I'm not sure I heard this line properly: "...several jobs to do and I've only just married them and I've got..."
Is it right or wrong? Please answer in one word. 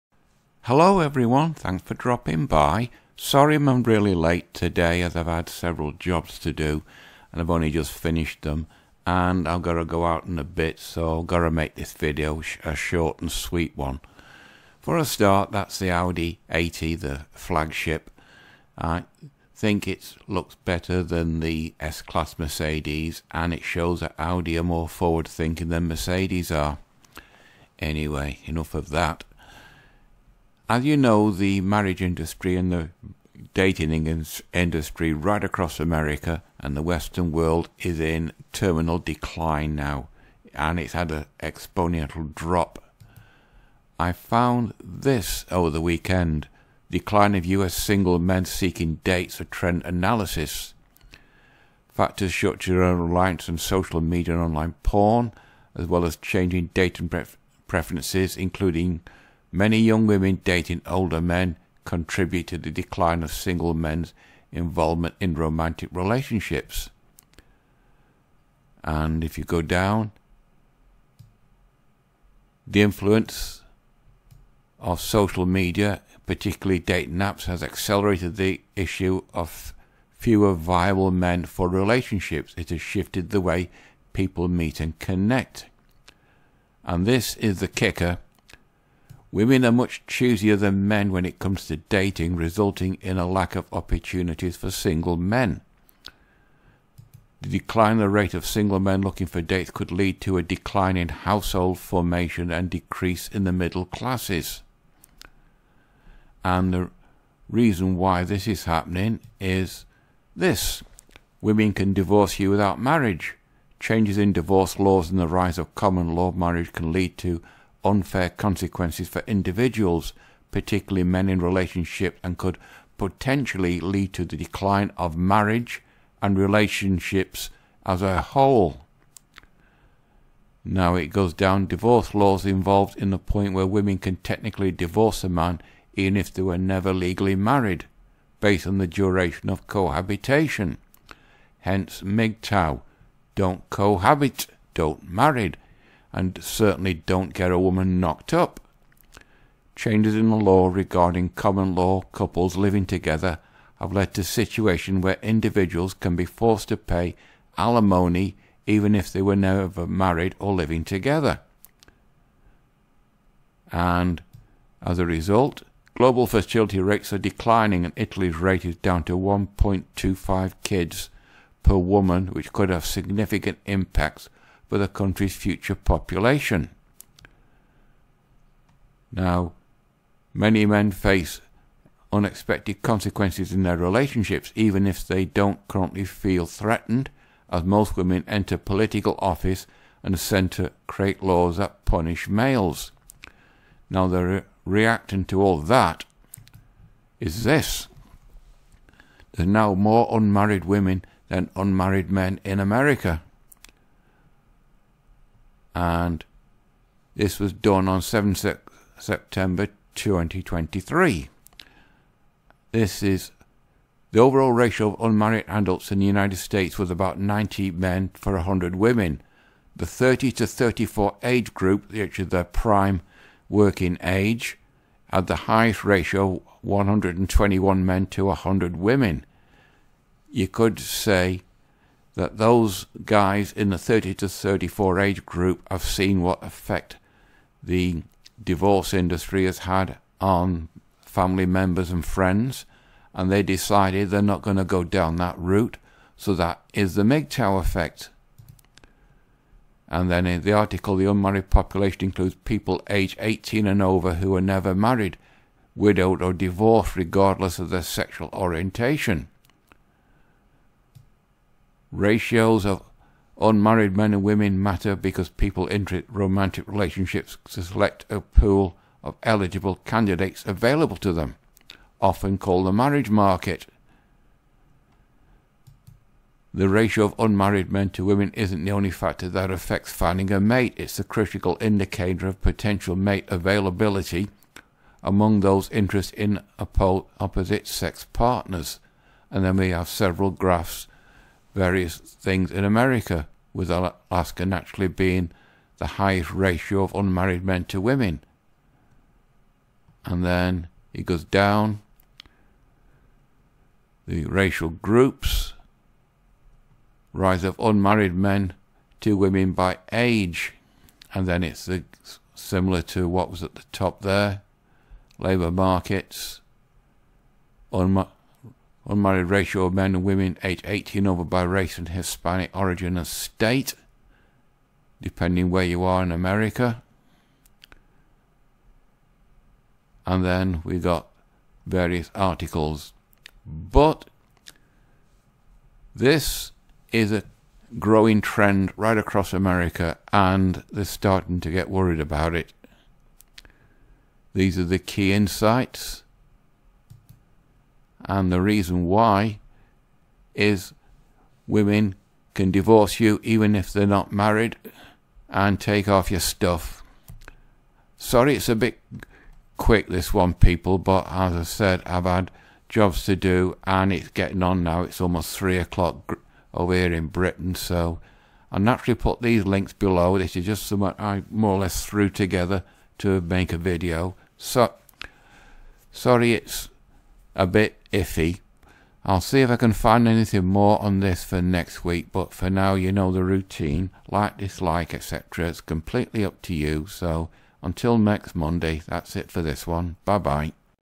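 wrong.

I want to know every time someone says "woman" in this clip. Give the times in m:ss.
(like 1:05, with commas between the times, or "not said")
2:27, 2:51.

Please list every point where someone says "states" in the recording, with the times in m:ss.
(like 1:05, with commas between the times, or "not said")
3:36, 5:23.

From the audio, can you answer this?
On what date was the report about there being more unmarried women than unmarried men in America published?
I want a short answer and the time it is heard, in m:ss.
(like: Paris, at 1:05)
7 September 2023, at 3:28.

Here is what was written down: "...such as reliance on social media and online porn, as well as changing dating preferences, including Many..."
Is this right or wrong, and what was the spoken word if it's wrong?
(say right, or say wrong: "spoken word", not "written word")
right.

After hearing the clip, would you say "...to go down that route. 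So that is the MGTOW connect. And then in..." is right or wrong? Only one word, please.
wrong.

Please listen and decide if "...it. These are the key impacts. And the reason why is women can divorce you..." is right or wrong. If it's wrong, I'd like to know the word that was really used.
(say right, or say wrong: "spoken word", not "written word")
wrong: "insights", not "impacts".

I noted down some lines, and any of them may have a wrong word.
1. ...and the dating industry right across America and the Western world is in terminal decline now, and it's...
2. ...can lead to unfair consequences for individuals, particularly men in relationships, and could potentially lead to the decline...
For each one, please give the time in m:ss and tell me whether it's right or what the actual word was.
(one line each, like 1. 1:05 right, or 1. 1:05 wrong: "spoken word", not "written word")
1. 0:32 right
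2. 1:56 right.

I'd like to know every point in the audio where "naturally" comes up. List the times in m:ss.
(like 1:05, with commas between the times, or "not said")
4:54, 6:08.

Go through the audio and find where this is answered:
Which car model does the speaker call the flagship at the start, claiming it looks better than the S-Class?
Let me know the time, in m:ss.
0:15.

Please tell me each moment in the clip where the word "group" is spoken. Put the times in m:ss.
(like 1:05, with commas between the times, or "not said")
3:41, 3:55, 5:04.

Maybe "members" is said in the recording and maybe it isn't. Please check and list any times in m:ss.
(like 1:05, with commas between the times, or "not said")
4:01.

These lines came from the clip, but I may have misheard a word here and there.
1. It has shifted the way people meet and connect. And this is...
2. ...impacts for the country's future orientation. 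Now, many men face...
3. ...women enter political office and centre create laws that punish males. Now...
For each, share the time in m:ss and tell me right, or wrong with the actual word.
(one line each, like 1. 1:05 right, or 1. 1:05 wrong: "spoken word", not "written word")
1. 1:22 right
2. 2:53 wrong: "population", not "orientation"
3. 3:07 right.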